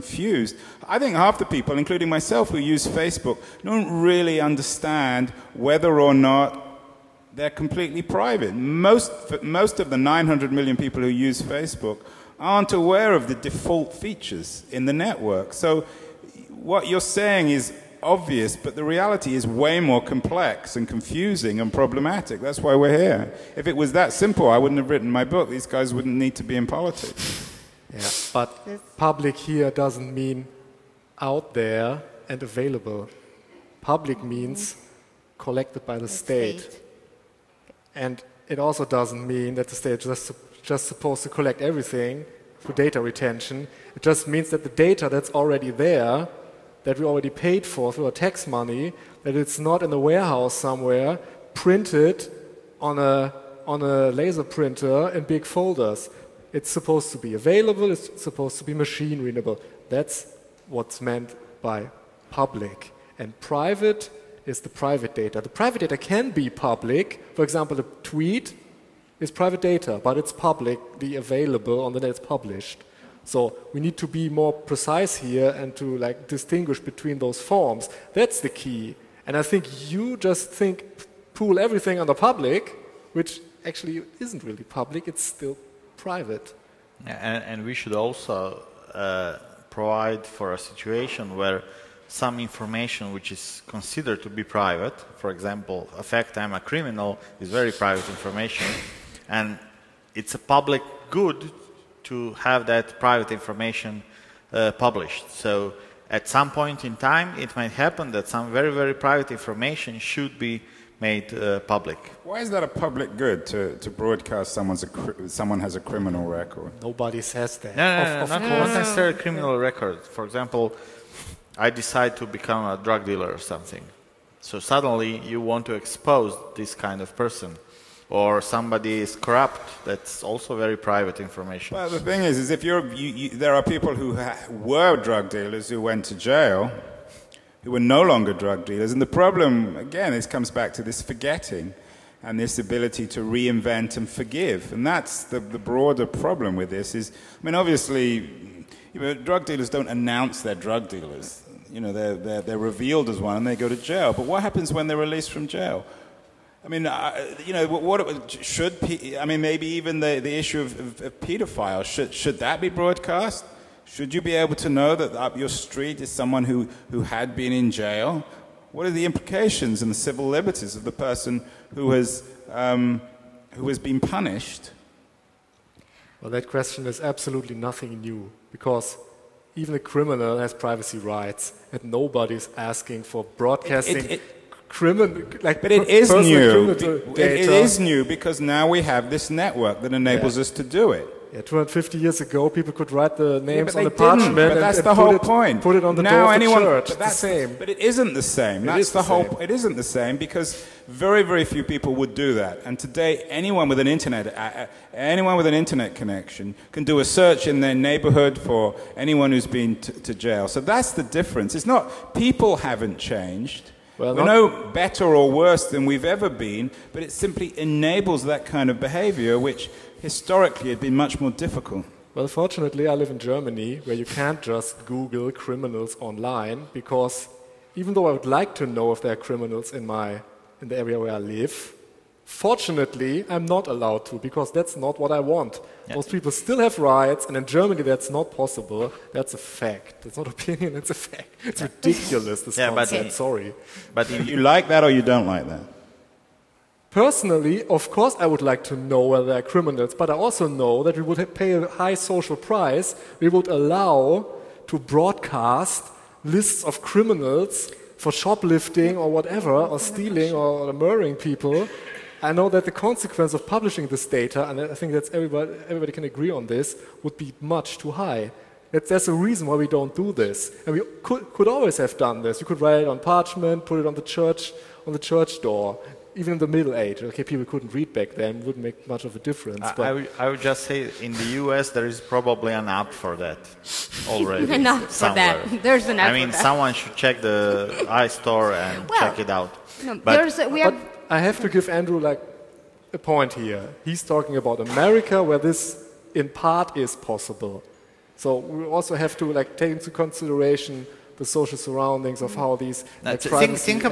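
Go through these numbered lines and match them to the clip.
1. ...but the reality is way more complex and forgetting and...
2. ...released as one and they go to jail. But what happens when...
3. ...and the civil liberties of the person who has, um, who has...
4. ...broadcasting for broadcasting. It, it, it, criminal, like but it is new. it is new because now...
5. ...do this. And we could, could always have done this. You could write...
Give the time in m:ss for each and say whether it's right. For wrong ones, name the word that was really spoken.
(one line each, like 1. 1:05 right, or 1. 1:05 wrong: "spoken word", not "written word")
1. 0:18 wrong: "confusing", not "forgetting"
2. 2:32 wrong: "revealed", not "released"
3. 2:49 right
4. 3:02 wrong: "asking", not "broadcasting"
5. 4:29 right.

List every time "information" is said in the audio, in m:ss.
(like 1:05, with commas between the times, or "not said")
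1:32, 1:38, 1:43, 1:49, 2:11.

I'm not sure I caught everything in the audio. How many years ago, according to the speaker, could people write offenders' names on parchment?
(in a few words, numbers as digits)
250.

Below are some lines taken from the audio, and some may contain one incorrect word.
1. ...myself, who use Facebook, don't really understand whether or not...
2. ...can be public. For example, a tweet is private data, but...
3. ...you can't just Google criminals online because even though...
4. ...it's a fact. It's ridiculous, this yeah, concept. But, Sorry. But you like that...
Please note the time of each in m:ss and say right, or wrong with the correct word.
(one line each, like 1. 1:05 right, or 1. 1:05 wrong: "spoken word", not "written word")
1. 0:02 right
2. 1:05 right
3. 3:43 right
4. 4:00 right.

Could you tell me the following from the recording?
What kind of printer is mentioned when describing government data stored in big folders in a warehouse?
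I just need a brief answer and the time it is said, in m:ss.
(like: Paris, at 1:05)
laser printer, at 0:54.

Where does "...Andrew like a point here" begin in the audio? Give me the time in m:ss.
4:51.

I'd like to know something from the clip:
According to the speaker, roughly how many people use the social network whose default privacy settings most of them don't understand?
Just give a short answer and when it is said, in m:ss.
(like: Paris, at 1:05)
900 million, at 0:09.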